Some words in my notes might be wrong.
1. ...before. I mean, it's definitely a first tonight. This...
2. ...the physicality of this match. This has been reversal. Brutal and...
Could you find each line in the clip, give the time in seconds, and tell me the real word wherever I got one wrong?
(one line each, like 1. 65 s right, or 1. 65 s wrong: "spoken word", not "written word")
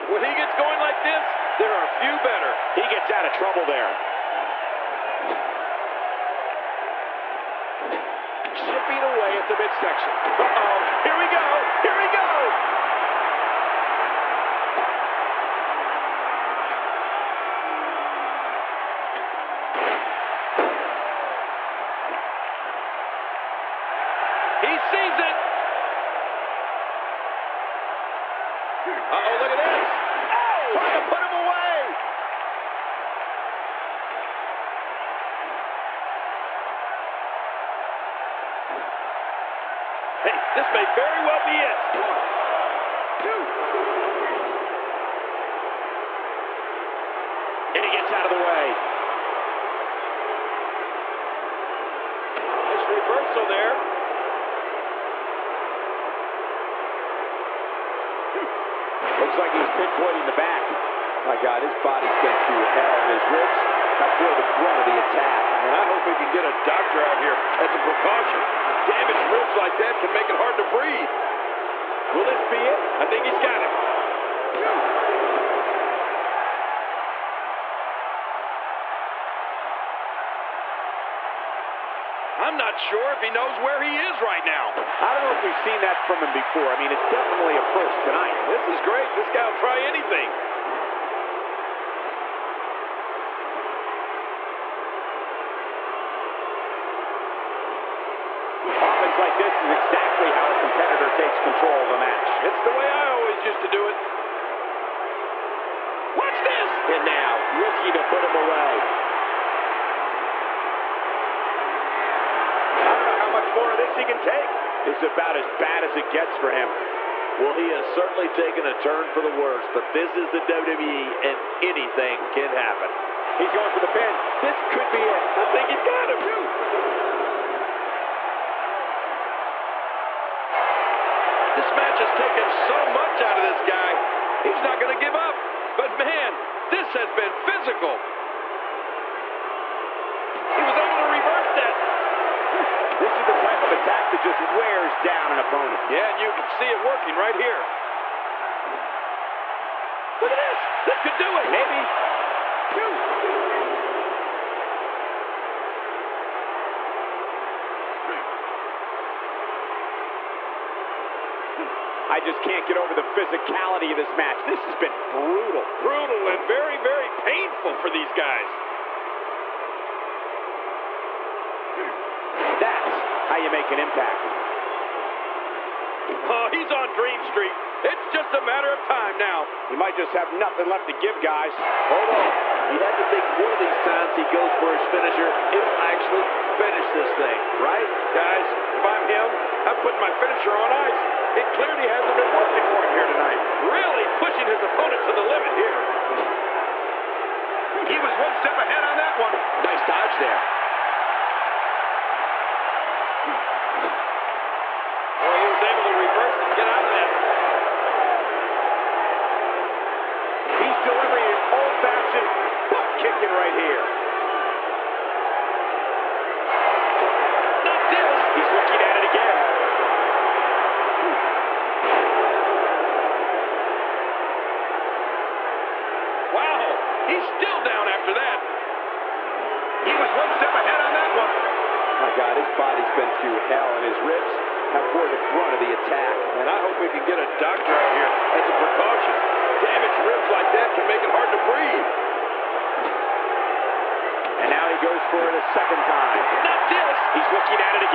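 1. 86 s right
2. 162 s wrong: "brutal", not "reversal".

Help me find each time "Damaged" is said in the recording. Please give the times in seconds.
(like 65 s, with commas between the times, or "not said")
68 s, 239 s.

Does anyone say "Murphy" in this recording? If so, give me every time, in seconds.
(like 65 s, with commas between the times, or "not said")
not said.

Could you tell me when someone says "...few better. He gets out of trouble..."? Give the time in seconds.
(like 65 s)
1 s.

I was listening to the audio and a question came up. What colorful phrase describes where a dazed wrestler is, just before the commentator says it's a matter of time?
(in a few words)
Dream Street.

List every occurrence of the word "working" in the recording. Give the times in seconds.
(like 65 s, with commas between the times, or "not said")
146 s, 192 s.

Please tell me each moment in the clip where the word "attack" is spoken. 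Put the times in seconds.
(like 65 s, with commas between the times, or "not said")
65 s, 143 s, 235 s.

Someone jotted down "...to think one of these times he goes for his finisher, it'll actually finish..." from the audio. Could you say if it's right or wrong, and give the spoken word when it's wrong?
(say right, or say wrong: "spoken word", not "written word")
right.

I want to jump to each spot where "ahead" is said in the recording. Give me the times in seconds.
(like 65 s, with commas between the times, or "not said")
198 s, 230 s.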